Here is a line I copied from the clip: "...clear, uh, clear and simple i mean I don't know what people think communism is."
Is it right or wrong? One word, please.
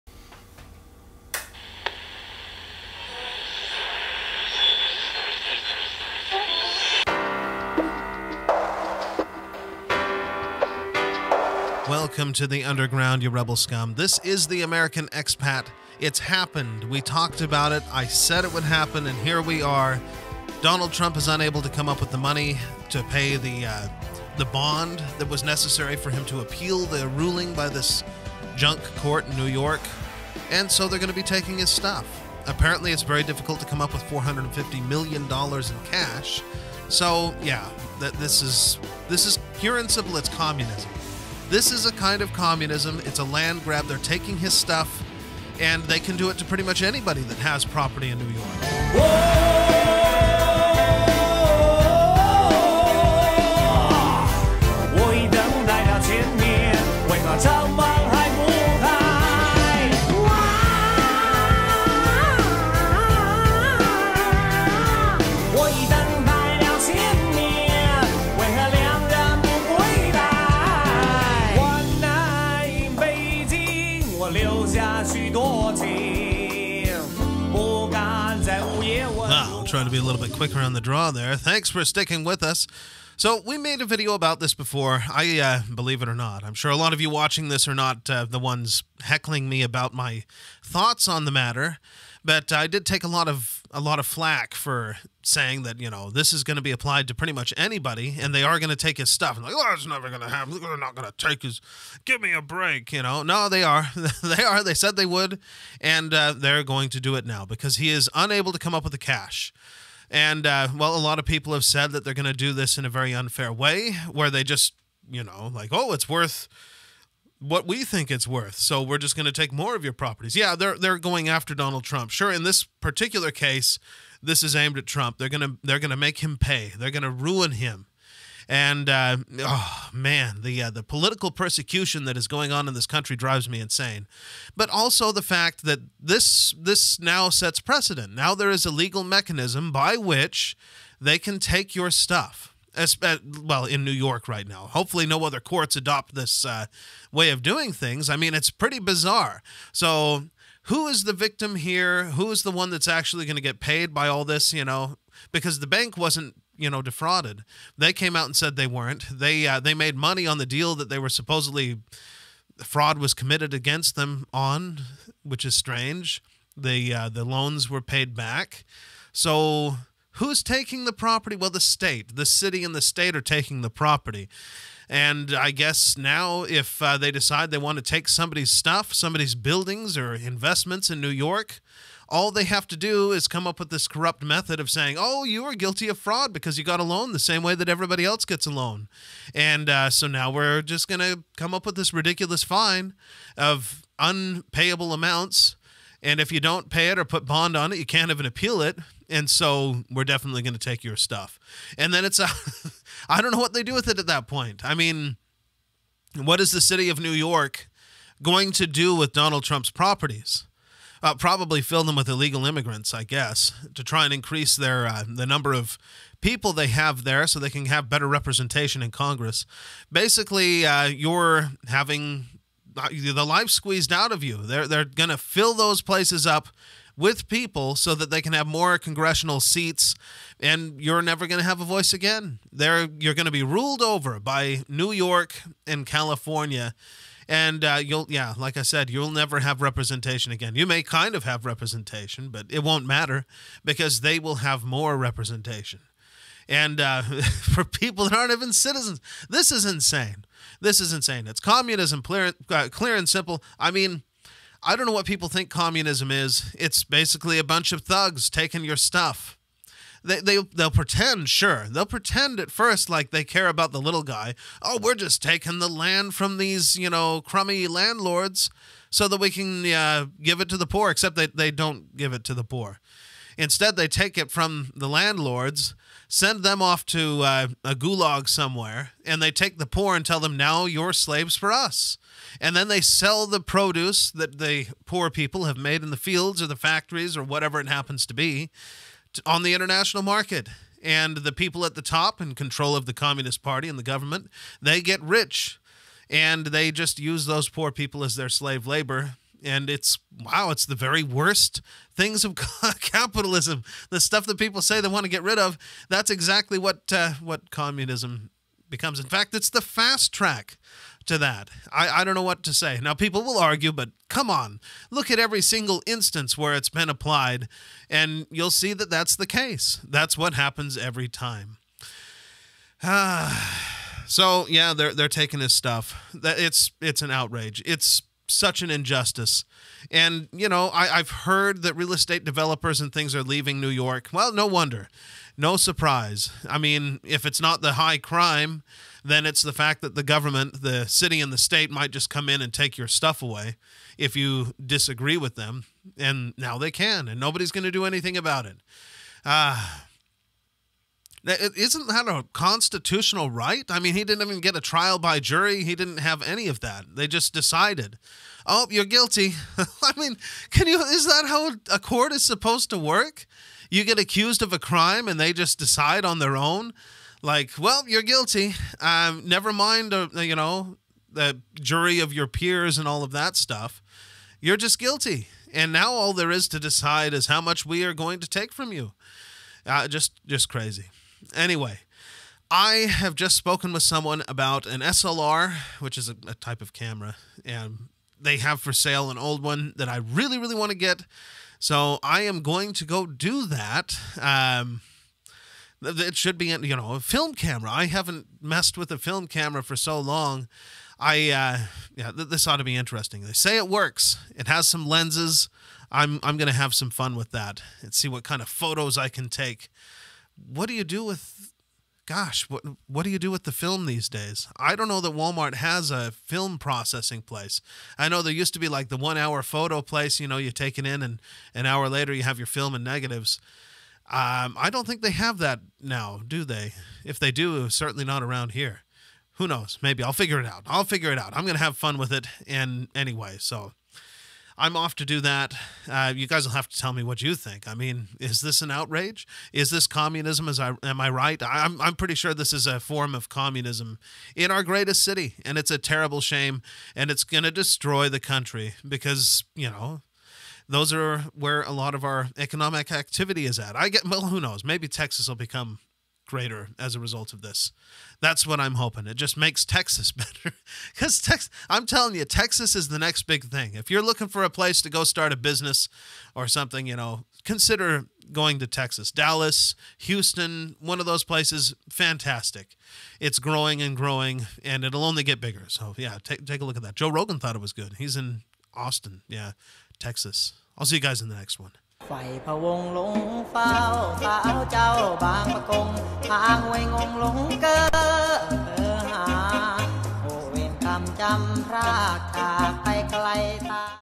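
right.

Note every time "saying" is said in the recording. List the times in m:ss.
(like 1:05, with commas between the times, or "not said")
1:35, 3:04.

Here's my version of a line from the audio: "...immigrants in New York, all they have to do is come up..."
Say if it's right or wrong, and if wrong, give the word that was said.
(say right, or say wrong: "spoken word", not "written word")
wrong: "investments", not "immigrants".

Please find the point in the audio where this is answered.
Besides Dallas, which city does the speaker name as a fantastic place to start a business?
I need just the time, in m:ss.
7:49.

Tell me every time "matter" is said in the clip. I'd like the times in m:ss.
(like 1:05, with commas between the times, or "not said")
1:31, 4:02.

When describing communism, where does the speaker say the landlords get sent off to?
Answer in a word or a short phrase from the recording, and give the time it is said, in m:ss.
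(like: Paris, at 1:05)
a gulag, at 4:37.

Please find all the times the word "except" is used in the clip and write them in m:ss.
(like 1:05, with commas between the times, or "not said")
4:30.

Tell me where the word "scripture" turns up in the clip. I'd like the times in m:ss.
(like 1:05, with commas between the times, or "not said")
not said.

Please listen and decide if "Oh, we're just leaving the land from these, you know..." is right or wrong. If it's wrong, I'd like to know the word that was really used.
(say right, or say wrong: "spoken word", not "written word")
wrong: "taking", not "leaving".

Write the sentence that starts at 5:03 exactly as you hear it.
The stuff that people say they want to get rid of.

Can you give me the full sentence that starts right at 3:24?
I mean, what is the city of New York going to do with Donald Trump's properties?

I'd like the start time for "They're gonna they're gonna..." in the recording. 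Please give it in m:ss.
2:05.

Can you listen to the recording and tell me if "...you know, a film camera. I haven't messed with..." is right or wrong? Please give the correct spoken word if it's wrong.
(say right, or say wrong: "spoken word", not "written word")
right.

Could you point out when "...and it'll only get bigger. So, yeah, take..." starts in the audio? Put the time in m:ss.
7:54.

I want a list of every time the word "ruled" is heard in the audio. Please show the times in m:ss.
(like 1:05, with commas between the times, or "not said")
3:53.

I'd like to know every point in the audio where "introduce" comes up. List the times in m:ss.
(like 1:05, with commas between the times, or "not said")
not said.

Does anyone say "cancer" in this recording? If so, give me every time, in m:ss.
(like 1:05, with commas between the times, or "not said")
not said.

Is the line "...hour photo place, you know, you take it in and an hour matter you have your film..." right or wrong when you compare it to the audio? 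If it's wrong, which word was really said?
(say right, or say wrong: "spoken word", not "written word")
wrong: "later", not "matter".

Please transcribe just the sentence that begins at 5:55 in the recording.
He didn't have any of that.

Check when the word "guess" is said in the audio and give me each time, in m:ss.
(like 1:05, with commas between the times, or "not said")
2:55, 3:33.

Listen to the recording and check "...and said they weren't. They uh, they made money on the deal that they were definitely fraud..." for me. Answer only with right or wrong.
wrong.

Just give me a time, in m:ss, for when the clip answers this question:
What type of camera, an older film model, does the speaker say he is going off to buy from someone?
6:24.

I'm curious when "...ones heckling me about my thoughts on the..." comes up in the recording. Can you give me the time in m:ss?
1:28.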